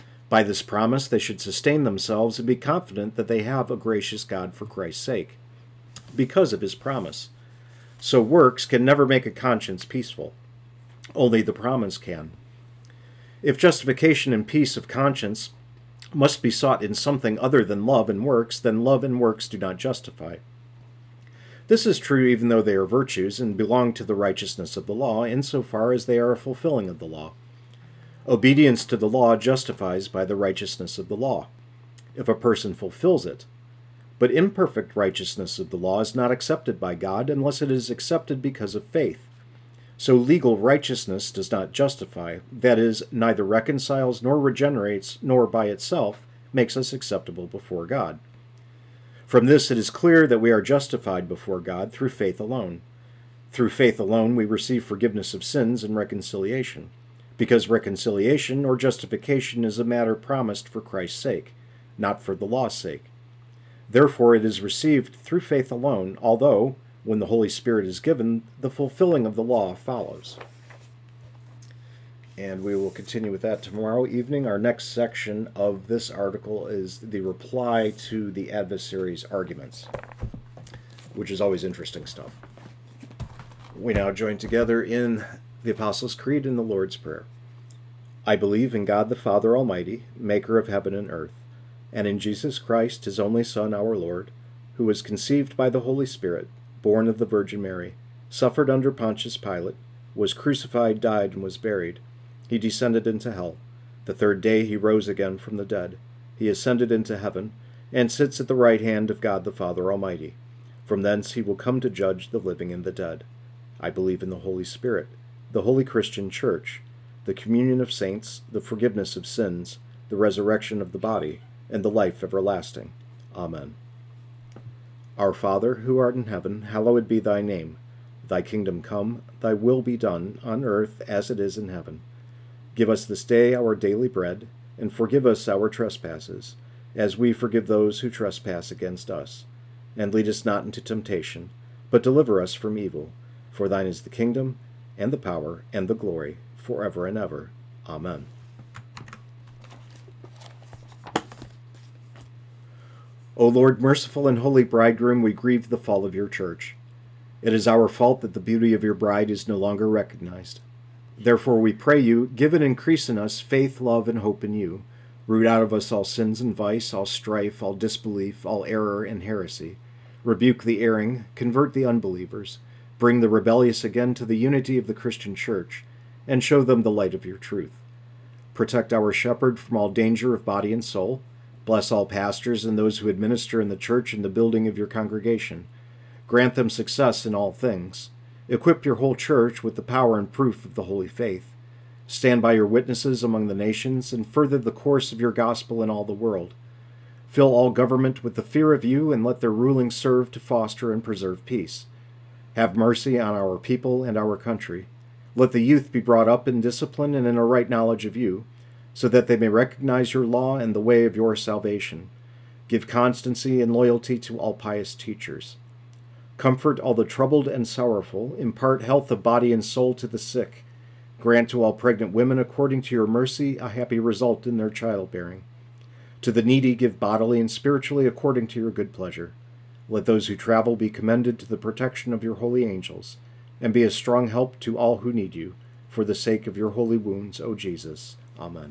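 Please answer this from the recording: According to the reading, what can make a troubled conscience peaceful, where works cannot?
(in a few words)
The promise.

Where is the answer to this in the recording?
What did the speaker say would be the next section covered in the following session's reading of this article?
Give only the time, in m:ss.
1:17.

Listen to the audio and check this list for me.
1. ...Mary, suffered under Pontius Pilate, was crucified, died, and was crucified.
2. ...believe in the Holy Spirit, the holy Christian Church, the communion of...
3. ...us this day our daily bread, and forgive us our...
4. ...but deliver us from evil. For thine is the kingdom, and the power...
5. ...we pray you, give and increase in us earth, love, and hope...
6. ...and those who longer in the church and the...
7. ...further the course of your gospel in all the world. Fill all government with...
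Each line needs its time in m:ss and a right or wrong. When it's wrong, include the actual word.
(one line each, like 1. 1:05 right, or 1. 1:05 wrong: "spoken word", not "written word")
1. 1:37 wrong: "buried", not "crucified"
2. 1:53 right
3. 2:12 right
4. 2:21 right
5. 2:41 wrong: "faith", not "earth"
6. 3:02 wrong: "administer", not "longer"
7. 3:14 right.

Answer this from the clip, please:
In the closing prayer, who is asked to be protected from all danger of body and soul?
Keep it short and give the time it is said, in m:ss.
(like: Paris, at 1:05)
Our shepherd, at 2:58.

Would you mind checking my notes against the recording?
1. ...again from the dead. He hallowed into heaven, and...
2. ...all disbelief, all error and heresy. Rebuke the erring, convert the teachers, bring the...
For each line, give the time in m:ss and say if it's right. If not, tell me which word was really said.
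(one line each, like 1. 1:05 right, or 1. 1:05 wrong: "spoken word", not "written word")
1. 1:45 wrong: "ascended", not "hallowed"
2. 2:47 wrong: "unbelievers", not "teachers".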